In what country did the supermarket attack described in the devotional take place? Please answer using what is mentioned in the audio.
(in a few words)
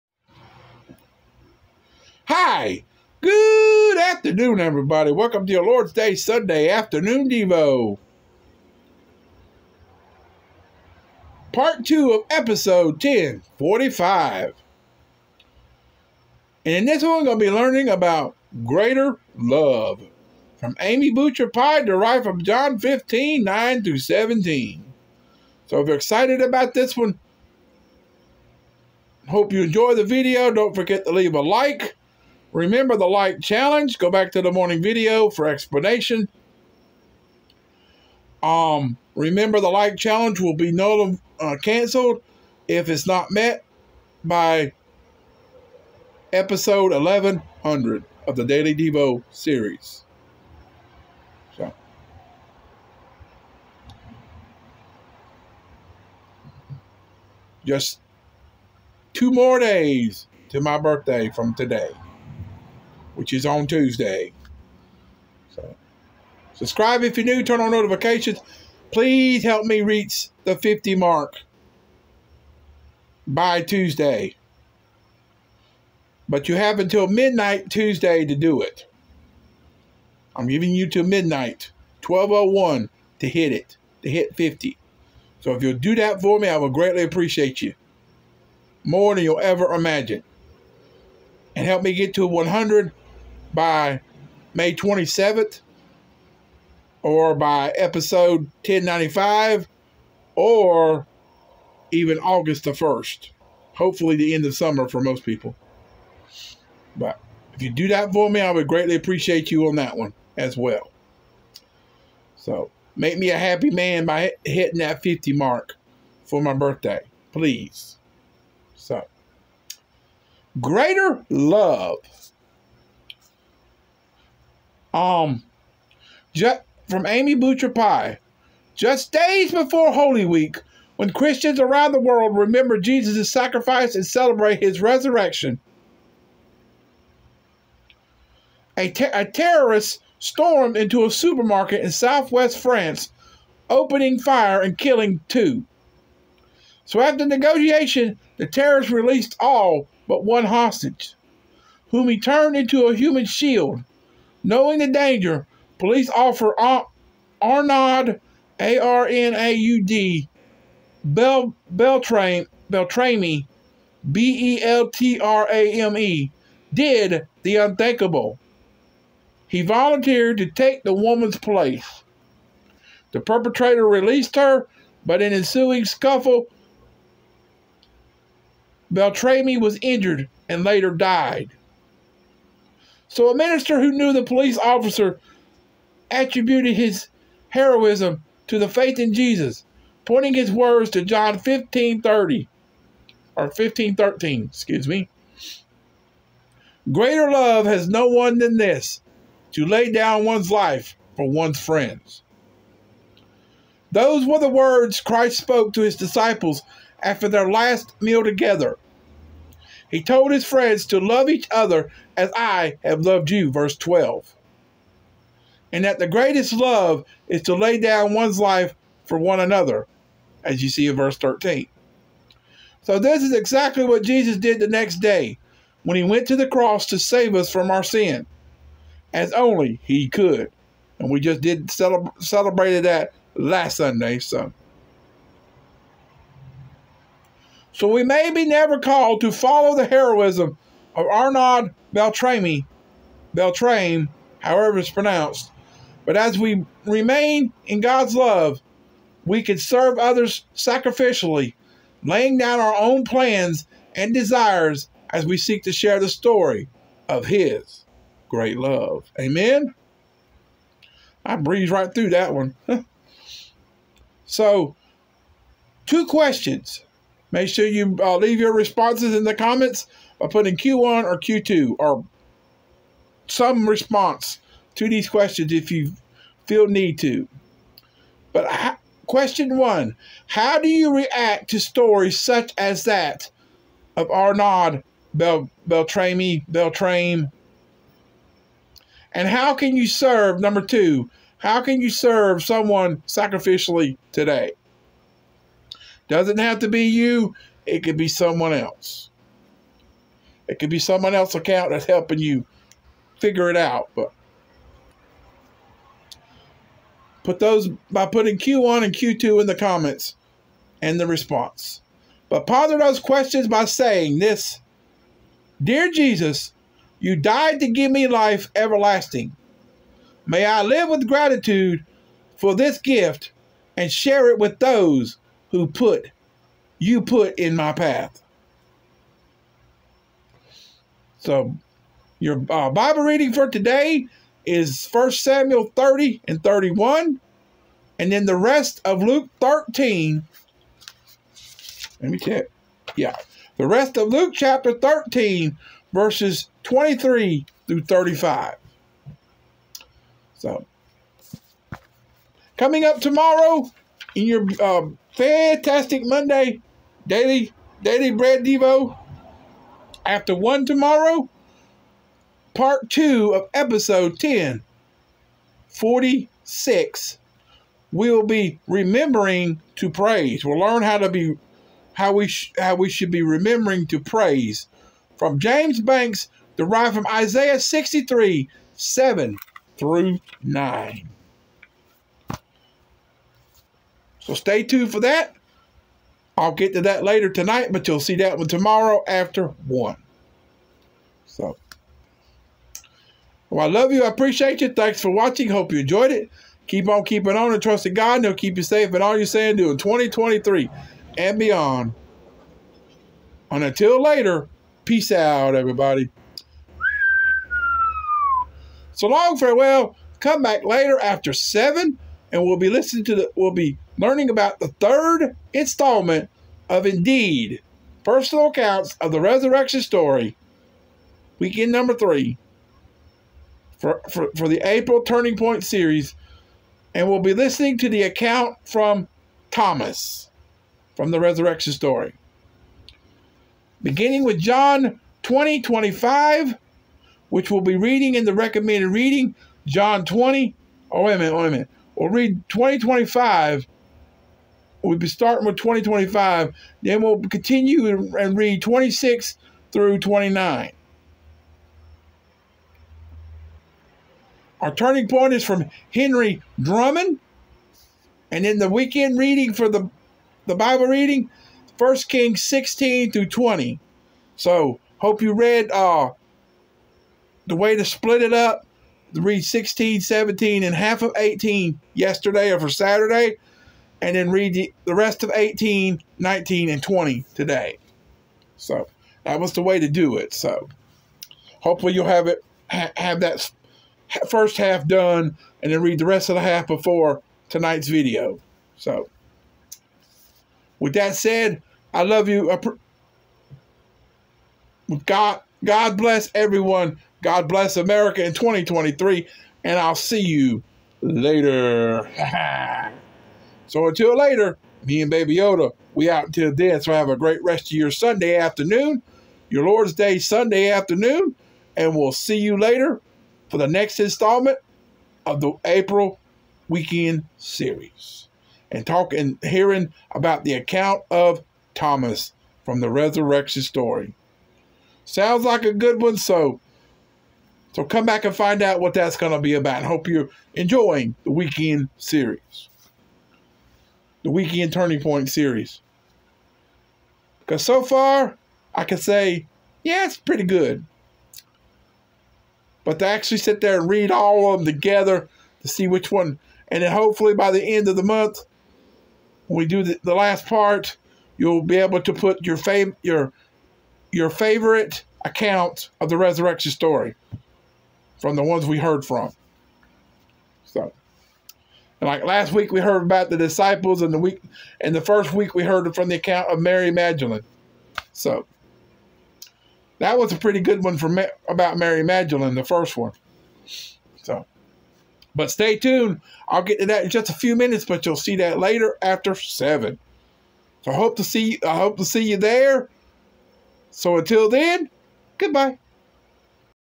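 France.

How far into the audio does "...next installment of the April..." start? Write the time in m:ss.
8:33.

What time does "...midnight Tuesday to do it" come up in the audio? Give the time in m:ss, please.
1:17.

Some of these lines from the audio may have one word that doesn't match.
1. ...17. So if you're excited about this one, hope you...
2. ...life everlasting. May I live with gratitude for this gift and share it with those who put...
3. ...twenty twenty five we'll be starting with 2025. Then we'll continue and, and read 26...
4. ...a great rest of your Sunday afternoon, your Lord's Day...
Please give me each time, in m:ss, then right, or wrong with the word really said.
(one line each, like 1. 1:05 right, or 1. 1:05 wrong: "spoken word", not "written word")
1. 0:23 right
2. 5:18 right
3. 7:22 right
4. 8:27 right.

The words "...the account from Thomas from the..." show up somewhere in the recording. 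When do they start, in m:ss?
7:07.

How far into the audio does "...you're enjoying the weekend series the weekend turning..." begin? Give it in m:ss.
8:50.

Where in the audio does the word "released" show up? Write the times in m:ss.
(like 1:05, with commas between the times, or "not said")
2:28, 2:53.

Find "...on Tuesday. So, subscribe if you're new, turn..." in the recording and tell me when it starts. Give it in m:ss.
1:03.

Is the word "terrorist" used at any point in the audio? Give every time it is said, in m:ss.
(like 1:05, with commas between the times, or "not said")
2:19, 2:28.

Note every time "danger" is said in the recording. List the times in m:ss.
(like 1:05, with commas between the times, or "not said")
2:34.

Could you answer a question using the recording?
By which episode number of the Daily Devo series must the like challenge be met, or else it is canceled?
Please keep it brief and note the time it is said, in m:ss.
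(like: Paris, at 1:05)
1100, at 0:46.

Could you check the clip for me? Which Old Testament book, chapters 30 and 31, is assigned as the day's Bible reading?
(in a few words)
1 Samuel.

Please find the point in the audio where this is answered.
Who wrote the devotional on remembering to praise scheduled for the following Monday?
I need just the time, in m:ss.
6:15.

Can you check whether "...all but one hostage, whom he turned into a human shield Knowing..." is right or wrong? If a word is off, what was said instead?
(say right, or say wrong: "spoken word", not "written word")
right.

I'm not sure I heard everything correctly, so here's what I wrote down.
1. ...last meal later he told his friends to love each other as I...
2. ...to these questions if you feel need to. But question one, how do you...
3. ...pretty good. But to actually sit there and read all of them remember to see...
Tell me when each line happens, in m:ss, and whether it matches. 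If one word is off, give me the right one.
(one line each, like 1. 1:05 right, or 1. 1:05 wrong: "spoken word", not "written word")
1. 3:27 wrong: "together", not "later"
2. 4:34 right
3. 9:00 wrong: "together", not "remember".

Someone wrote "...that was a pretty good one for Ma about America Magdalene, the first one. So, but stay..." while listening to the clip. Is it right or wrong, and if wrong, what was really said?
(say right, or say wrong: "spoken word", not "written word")
wrong: "Mary", not "America".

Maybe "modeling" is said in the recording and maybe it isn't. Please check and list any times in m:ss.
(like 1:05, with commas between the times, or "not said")
not said.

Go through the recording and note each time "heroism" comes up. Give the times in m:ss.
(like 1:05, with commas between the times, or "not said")
3:07, 3:59.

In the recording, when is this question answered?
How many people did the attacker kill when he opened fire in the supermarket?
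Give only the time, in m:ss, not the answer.
2:24.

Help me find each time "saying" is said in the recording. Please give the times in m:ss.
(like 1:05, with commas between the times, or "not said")
5:13, 6:39.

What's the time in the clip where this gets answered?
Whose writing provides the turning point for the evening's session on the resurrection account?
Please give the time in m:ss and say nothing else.
7:35.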